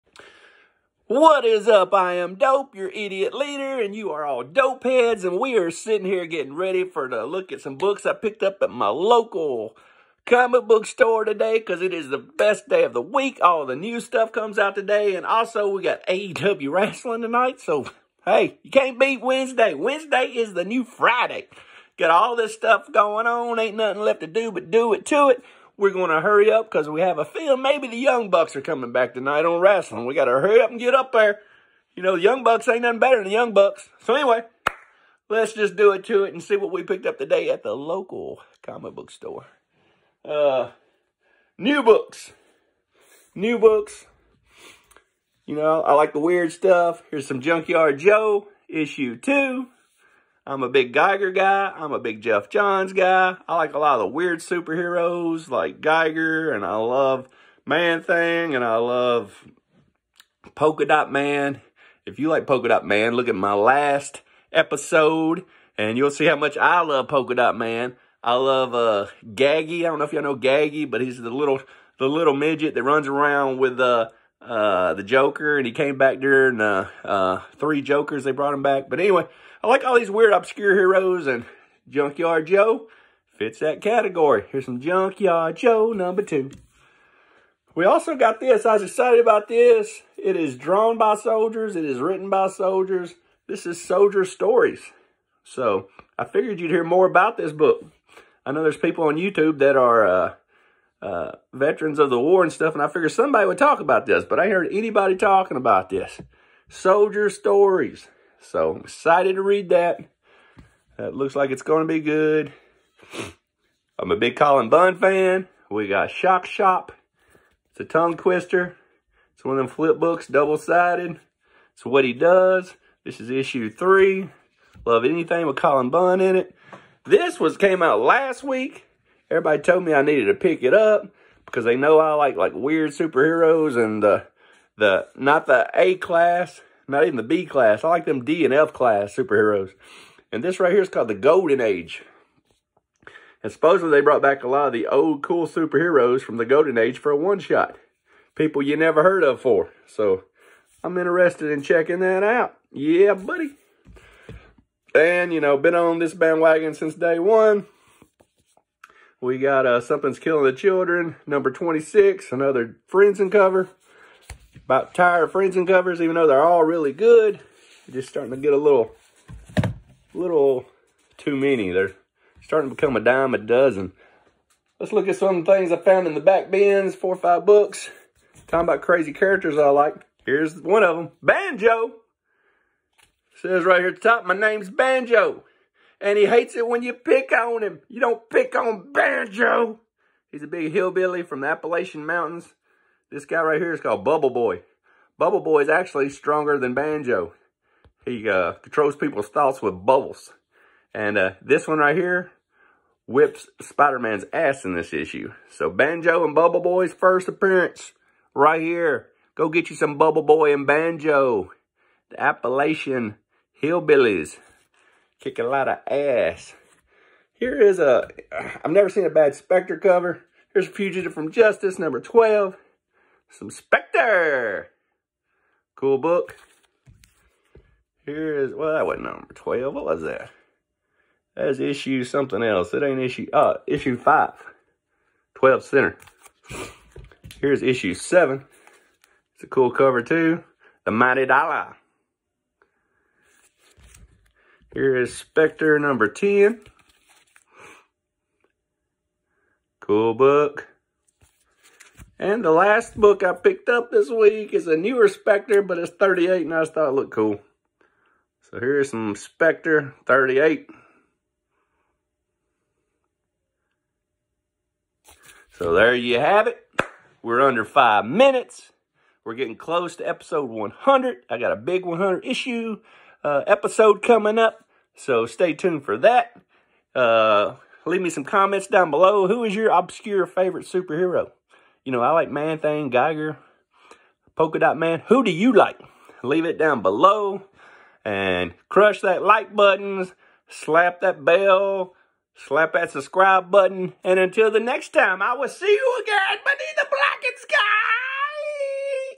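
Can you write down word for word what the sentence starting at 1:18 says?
But anyway, I like all these weird, obscure heroes, and Junkyard Joe fits that category.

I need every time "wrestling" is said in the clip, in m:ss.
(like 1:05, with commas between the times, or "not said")
0:16, 0:29.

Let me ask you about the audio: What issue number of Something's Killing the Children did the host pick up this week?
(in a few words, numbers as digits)
26.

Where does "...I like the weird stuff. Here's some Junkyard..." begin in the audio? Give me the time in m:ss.
0:45.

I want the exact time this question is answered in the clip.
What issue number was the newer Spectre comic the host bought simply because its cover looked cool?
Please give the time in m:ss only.
4:15.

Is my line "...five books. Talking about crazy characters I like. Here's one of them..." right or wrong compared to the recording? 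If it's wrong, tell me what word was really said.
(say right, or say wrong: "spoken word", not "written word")
right.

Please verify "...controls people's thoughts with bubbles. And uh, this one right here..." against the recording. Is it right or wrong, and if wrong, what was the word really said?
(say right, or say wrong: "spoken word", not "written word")
right.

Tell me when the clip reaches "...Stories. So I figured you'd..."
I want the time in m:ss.
1:34.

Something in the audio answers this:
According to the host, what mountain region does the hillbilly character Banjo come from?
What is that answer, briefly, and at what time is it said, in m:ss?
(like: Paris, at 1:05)
Appalachian Mountains, at 3:11.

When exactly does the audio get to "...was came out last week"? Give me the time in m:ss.
2:07.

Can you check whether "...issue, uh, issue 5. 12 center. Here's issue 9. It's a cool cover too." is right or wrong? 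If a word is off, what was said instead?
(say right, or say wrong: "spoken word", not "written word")
wrong: "7", not "9".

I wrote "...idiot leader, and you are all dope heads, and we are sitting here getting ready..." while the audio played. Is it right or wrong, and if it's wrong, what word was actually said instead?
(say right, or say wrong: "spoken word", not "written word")
right.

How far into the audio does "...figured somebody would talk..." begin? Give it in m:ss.
1:42.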